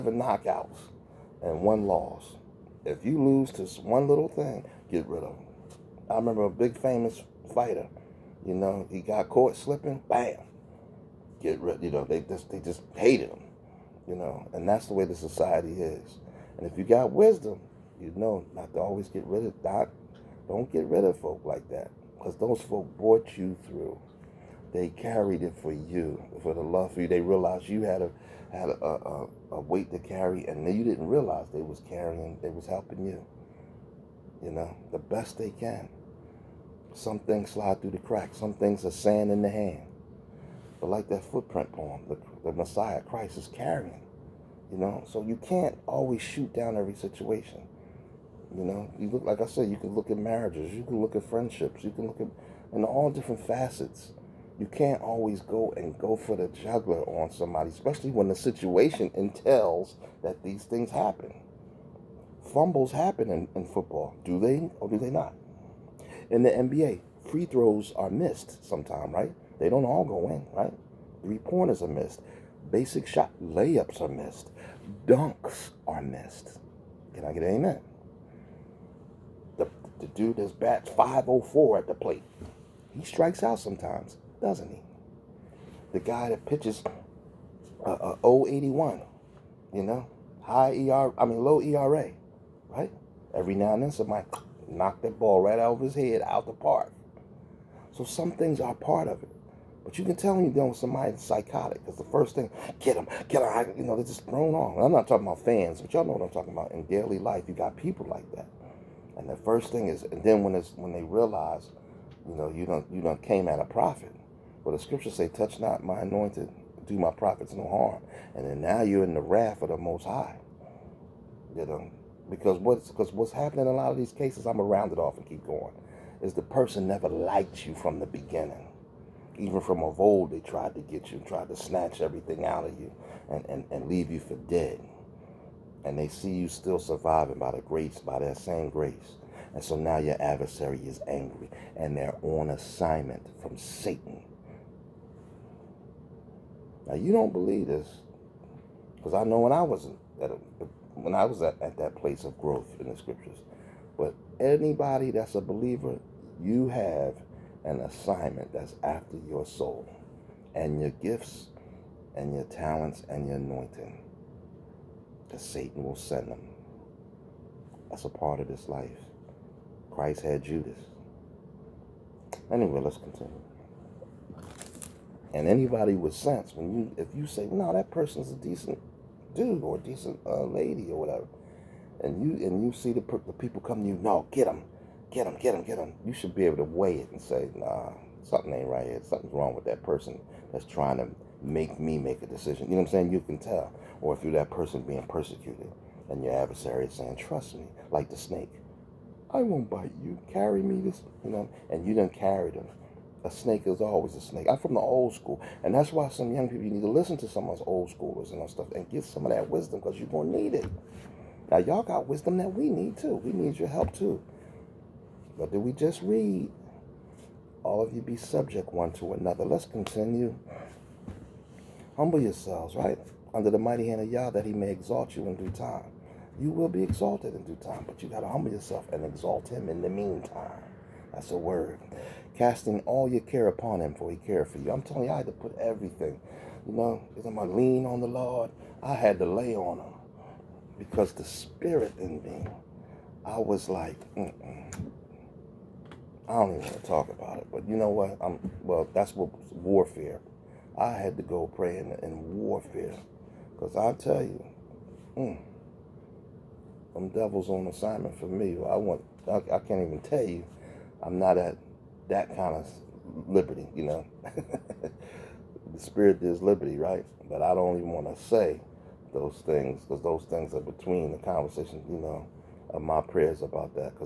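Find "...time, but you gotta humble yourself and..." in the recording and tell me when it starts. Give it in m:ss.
3:47.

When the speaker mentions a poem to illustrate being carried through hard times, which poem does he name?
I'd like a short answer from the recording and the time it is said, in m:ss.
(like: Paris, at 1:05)
Footprint poem, at 0:41.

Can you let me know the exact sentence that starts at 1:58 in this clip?
And then now you're in the wrath of the Most High.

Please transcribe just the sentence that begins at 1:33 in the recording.
Every now and then somebody knocked that ball right out of his head out the park.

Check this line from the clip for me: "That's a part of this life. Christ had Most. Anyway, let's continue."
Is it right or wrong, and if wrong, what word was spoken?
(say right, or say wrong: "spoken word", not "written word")
wrong: "Judas", not "Most".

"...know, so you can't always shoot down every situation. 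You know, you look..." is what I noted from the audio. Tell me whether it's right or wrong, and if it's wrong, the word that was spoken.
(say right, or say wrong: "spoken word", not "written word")
right.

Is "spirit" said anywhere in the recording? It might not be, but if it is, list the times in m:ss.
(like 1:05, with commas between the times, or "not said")
4:01, 4:25.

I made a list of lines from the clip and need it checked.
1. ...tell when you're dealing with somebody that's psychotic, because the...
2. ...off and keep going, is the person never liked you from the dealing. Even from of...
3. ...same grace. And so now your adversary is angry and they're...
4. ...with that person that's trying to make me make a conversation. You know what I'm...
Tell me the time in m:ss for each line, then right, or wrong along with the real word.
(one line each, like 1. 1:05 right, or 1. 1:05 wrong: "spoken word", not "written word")
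1. 1:40 right
2. 2:04 wrong: "beginning", not "dealing"
3. 2:18 right
4. 3:09 wrong: "decision", not "conversation".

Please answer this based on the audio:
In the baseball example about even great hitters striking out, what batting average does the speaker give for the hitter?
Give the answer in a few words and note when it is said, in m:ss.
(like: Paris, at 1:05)
504, at 1:20.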